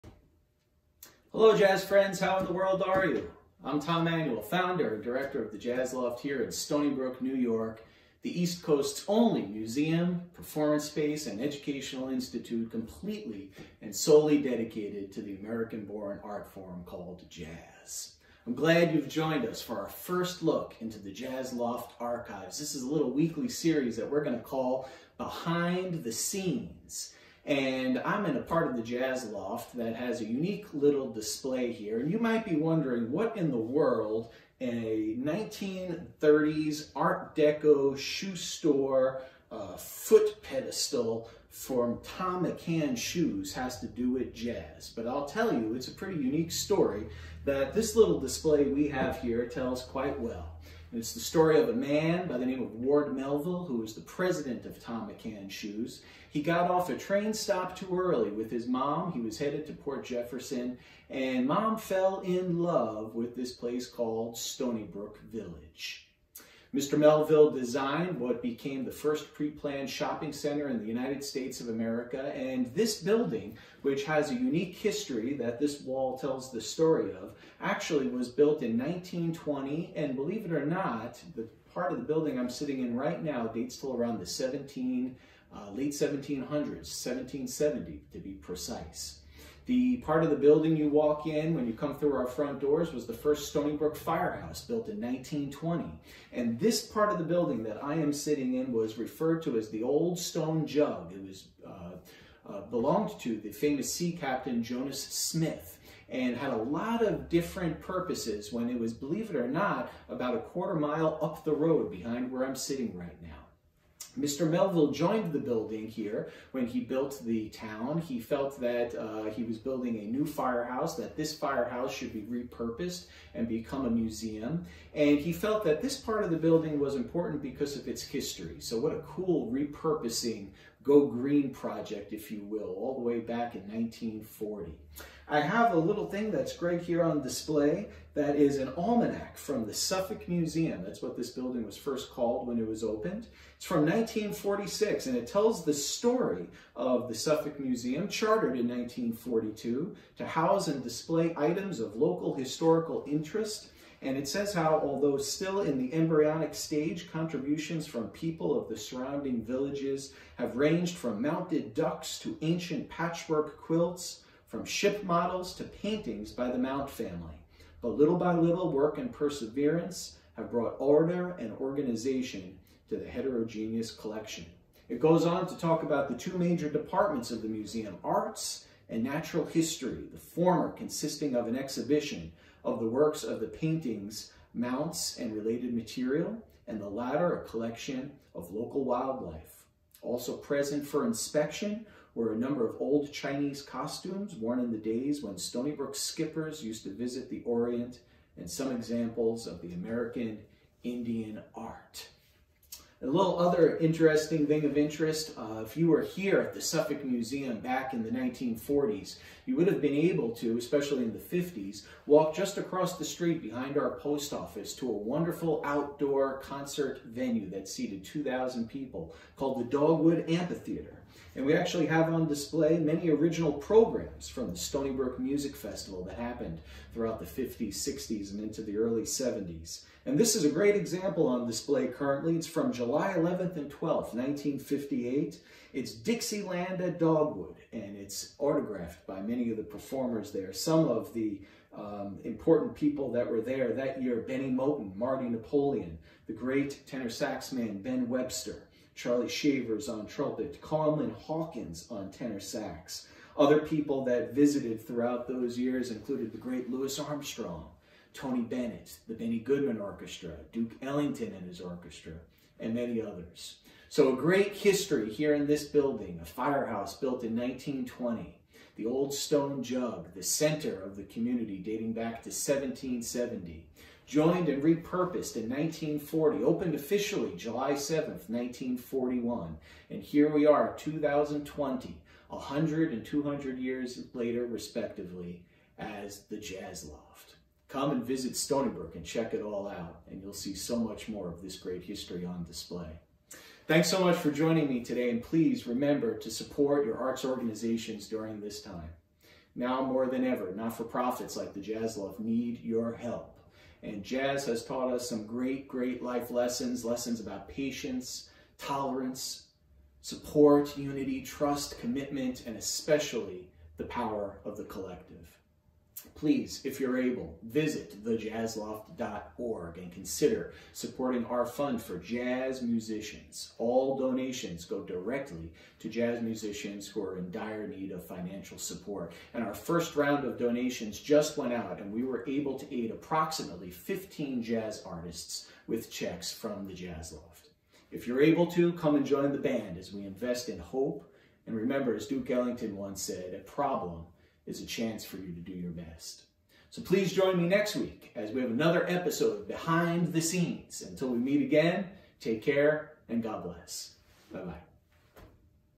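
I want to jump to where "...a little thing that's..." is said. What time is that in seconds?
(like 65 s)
135 s.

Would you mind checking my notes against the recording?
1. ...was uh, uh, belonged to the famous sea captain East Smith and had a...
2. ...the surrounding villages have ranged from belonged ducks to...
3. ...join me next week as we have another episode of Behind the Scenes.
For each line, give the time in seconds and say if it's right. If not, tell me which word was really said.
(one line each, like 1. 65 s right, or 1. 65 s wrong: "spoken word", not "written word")
1. 101 s wrong: "Jonas", not "East"
2. 158 s wrong: "mounted", not "belonged"
3. 347 s right.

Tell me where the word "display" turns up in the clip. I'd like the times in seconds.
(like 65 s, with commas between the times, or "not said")
31 s, 48 s, 137 s, 150 s, 222 s, 231 s, 292 s.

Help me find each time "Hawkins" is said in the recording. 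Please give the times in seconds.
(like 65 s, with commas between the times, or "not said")
251 s.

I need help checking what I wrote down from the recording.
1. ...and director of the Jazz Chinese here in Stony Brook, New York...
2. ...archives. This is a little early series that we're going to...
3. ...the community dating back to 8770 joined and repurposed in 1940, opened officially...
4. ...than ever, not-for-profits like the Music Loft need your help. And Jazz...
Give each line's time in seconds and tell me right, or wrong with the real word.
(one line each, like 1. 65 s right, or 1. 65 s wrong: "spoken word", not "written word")
1. 4 s wrong: "Loft", not "Chinese"
2. 22 s wrong: "weekly", not "early"
3. 270 s wrong: "1770", not "8770"
4. 300 s wrong: "Jazz", not "Music".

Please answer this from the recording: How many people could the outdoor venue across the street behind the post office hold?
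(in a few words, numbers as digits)
2,000.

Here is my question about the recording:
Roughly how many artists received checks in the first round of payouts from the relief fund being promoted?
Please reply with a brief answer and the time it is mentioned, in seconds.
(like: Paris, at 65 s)
15, at 333 s.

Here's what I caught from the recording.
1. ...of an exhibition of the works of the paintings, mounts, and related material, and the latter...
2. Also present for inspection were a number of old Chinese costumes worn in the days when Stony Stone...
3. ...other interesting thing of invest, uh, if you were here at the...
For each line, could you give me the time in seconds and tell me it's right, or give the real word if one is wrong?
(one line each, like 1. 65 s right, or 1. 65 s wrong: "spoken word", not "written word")
1. 181 s right
2. 190 s wrong: "Brook", not "Stone"
3. 203 s wrong: "interest", not "invest".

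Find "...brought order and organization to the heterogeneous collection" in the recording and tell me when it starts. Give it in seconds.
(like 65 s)
170 s.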